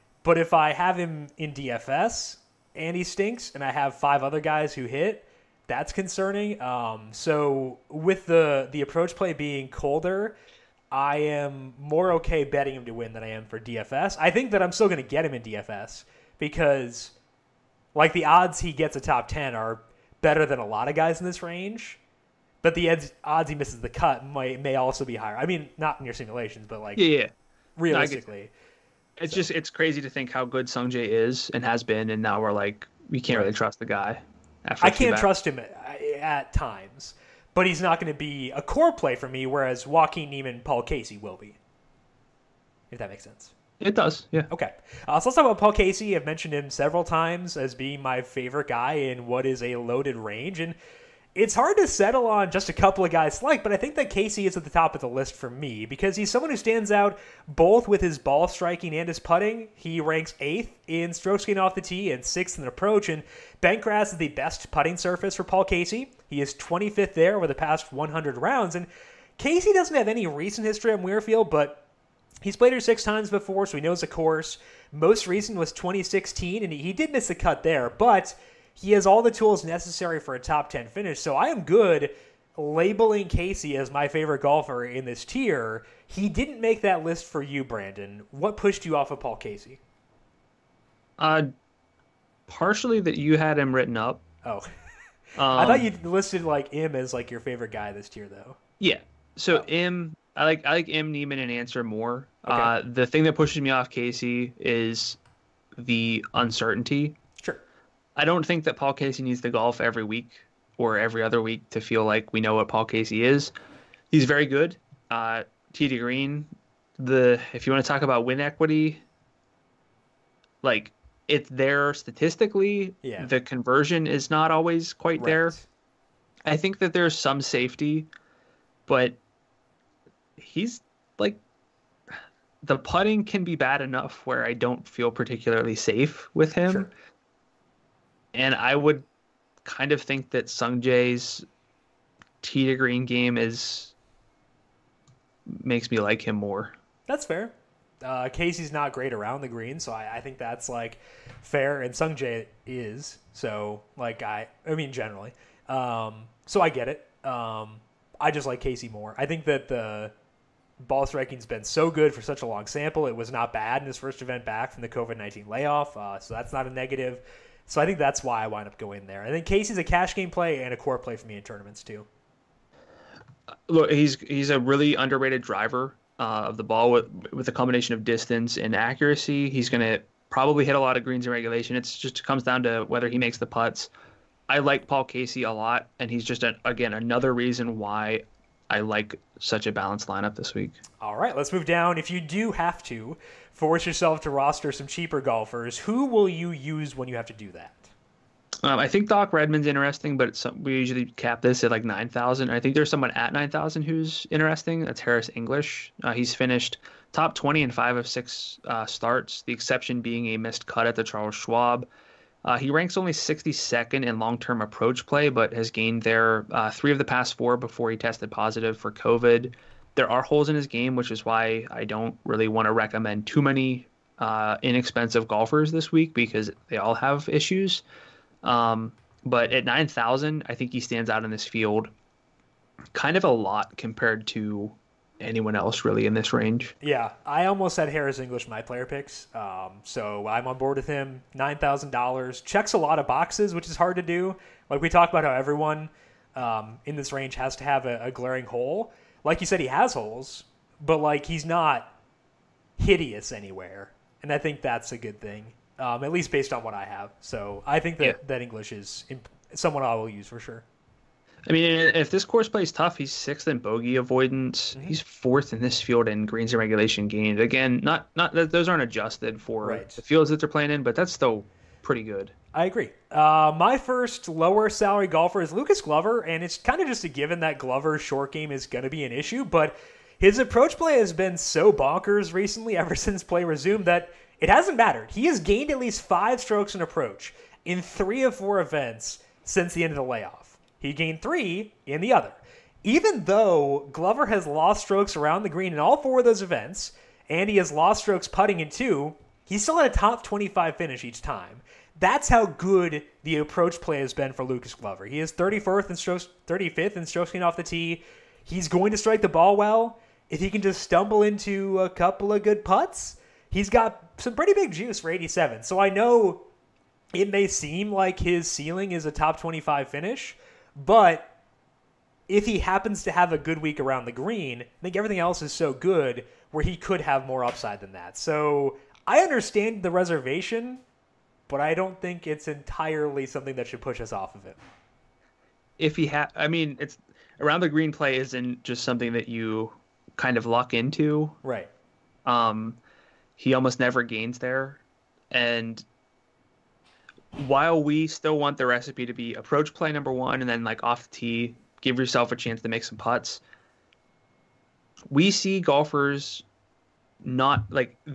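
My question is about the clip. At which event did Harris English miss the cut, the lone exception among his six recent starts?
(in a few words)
Charles Schwab.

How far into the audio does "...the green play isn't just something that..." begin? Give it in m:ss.
5:37.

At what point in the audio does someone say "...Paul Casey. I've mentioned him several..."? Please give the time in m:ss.
0:45.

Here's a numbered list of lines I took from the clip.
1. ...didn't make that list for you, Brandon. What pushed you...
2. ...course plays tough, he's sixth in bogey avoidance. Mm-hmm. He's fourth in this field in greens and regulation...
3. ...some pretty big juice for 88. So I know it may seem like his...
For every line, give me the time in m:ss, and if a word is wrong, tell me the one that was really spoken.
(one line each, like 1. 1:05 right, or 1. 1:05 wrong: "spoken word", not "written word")
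1. 1:26 right
2. 4:22 right
3. 5:14 wrong: "87", not "88".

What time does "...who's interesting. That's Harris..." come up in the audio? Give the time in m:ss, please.
3:23.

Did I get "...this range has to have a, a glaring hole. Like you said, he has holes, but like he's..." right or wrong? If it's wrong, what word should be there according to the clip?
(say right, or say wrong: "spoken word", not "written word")
right.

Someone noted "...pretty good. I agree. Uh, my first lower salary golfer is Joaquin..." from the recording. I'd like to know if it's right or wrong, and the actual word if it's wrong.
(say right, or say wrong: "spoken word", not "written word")
wrong: "Lucas", not "Joaquin".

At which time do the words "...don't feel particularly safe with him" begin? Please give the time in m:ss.
2:14.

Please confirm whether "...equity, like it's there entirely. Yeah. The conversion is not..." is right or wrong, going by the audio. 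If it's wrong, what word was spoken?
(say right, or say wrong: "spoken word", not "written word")
wrong: "statistically", not "entirely".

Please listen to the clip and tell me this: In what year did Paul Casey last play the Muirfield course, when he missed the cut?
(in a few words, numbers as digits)
2016.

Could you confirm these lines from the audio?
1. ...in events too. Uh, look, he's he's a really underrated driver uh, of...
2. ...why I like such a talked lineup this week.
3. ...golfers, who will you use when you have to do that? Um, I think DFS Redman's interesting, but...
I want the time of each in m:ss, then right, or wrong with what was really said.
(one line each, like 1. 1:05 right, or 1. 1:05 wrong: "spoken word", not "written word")
1. 2:51 wrong: "tournaments", not "events"
2. 3:07 wrong: "balanced", not "talked"
3. 3:15 wrong: "Doc", not "DFS".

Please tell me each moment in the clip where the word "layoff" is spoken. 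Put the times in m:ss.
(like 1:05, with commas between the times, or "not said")
2:45, 4:50.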